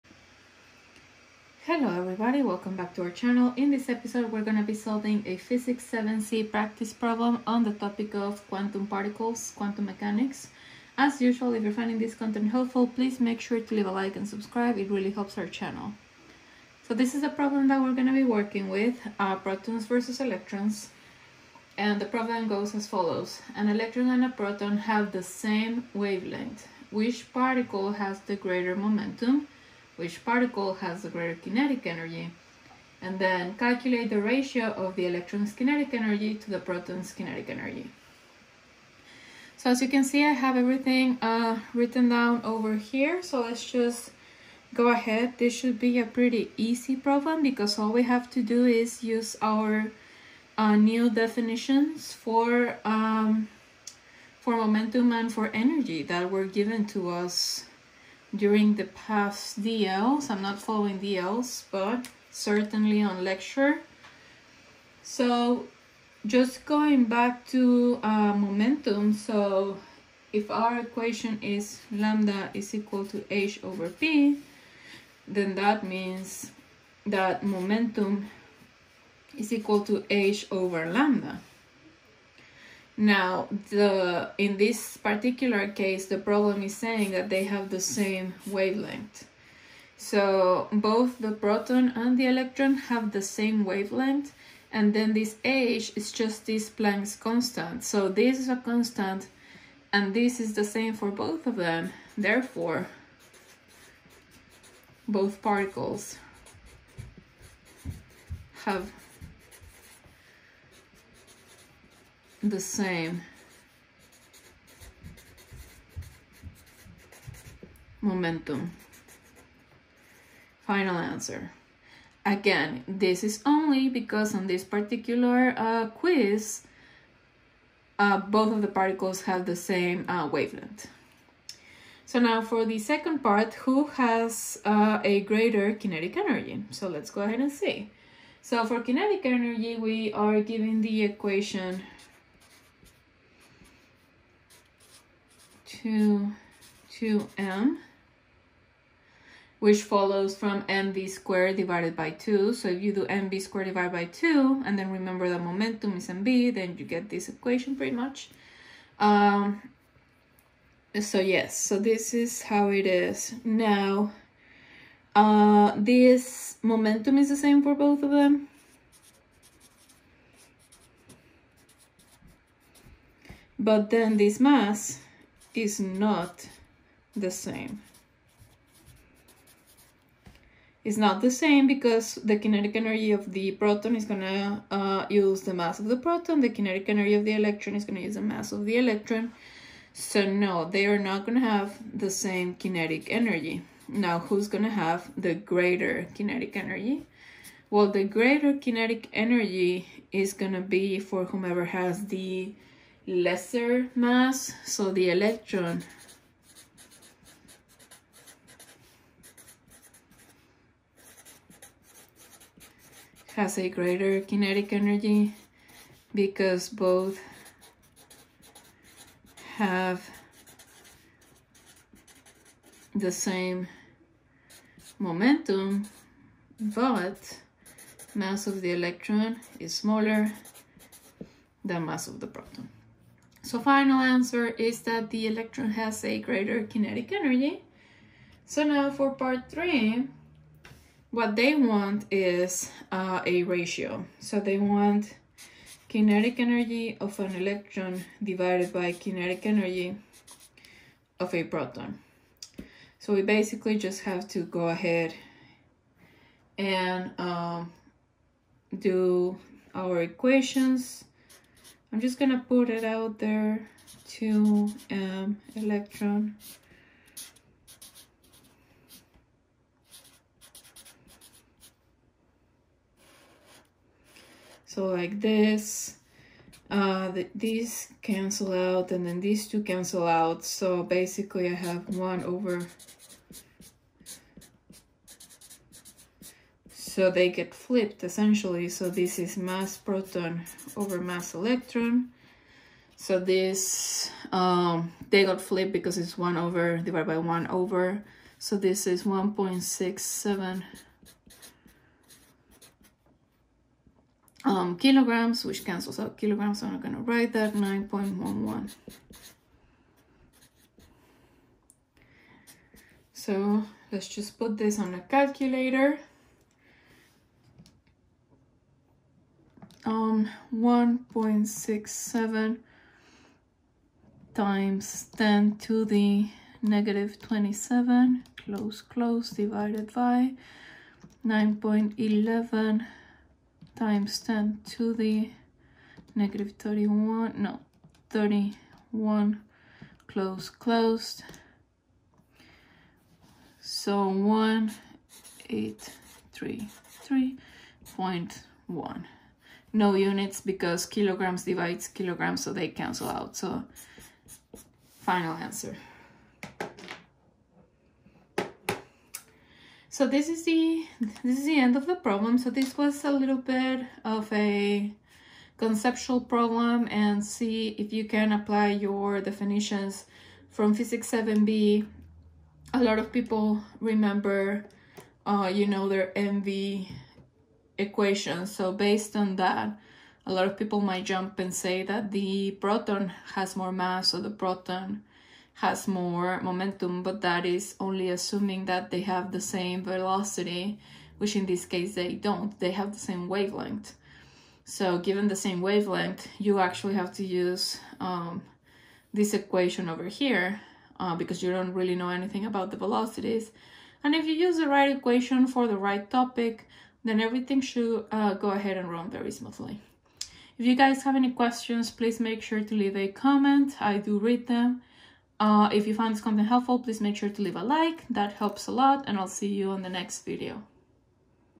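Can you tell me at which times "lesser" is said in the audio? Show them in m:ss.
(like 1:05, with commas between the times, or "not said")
3:23.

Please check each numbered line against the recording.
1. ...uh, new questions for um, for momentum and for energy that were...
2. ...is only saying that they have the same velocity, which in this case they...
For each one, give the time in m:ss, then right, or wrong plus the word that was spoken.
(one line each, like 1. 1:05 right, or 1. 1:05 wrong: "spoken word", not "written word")
1. 0:50 wrong: "definitions", not "questions"
2. 6:27 wrong: "assuming", not "saying".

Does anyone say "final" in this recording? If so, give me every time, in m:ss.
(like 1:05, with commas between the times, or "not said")
2:00, 3:53, 5:54.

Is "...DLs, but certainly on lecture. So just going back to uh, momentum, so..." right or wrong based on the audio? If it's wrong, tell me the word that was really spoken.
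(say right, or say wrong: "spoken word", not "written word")
right.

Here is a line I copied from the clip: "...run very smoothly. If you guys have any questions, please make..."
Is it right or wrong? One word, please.
right.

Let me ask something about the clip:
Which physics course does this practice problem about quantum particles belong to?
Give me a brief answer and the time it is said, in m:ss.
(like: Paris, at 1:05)
Physics 7c, at 0:05.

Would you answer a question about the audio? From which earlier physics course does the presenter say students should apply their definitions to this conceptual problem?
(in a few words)
Physics 7b.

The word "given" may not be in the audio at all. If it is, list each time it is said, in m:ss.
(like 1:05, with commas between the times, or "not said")
0:56, 2:20, 6:34.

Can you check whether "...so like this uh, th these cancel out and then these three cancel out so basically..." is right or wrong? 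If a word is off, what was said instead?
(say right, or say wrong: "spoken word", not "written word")
wrong: "two", not "three".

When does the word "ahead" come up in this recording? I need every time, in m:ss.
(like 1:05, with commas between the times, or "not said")
0:44, 2:17, 4:14, 6:48.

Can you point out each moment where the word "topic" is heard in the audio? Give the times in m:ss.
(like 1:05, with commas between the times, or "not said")
0:07, 6:46.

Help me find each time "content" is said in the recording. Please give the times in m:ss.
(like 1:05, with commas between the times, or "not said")
0:12, 6:56.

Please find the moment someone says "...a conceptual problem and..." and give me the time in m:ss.
6:04.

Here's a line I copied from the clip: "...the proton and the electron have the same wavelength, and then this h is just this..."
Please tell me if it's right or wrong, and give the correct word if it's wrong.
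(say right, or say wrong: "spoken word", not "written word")
right.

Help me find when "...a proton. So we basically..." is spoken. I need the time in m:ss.
4:11.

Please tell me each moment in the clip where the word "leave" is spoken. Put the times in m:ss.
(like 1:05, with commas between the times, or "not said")
0:13, 6:52, 6:57.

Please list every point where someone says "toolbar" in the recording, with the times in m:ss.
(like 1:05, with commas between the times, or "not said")
not said.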